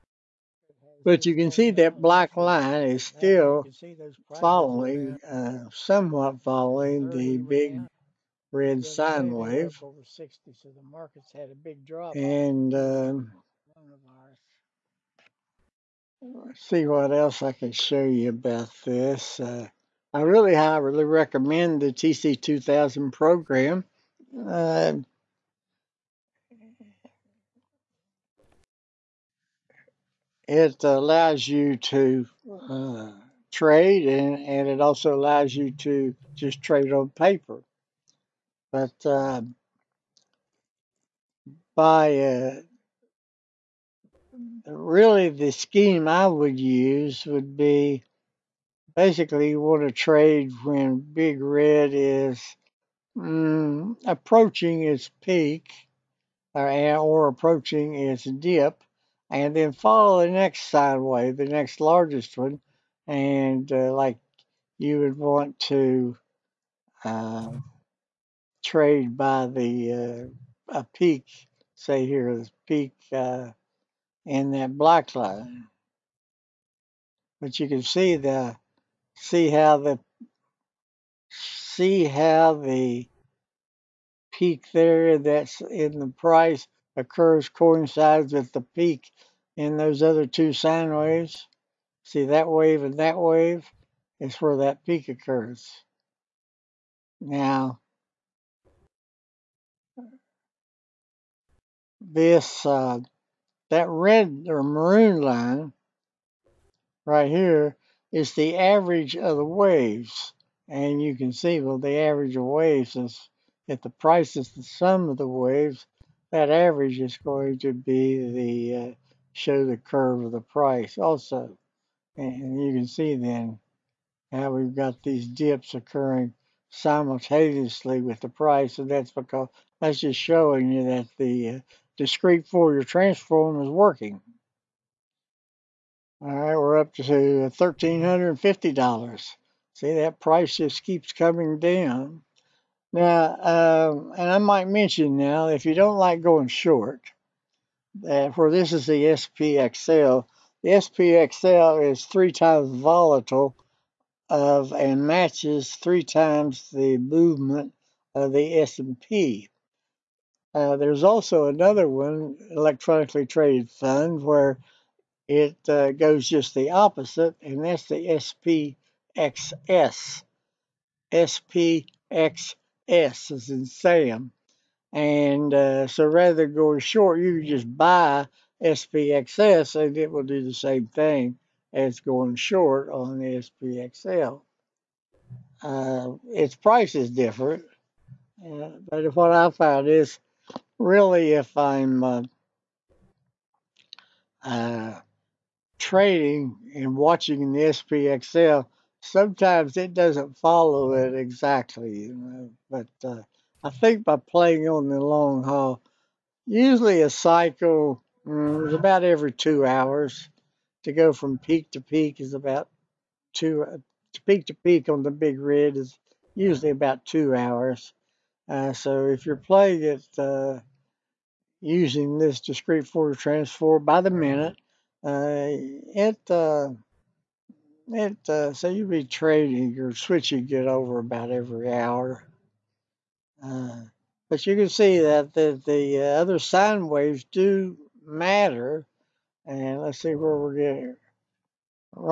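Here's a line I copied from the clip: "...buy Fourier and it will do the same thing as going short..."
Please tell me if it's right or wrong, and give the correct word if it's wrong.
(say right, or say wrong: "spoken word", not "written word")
wrong: "SPXS", not "Fourier".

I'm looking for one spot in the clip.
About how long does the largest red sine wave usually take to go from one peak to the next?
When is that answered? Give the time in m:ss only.
3:36.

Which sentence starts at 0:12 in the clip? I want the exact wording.
And uh, see what else I can show you about this.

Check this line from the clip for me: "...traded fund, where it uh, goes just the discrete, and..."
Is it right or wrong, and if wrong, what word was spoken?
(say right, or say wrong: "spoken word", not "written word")
wrong: "opposite", not "discrete".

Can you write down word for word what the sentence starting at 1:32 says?
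See that wave and that wave is where that peak occurs.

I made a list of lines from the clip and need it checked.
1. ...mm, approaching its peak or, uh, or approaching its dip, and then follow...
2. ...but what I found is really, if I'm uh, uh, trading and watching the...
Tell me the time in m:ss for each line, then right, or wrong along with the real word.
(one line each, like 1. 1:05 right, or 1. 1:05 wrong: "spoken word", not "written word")
1. 0:53 right
2. 3:08 right.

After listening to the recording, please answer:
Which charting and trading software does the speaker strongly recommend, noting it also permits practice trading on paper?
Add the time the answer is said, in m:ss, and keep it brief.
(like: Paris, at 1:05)
TC2000, at 0:21.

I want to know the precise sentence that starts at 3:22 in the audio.
But uh, I think by playing on the long haul, usually a cycle mm, is about every two hours.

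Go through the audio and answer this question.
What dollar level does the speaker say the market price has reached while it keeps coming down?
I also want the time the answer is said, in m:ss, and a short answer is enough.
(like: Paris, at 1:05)
$1,350, at 2:17.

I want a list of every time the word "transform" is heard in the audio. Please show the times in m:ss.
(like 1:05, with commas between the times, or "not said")
2:12, 3:43.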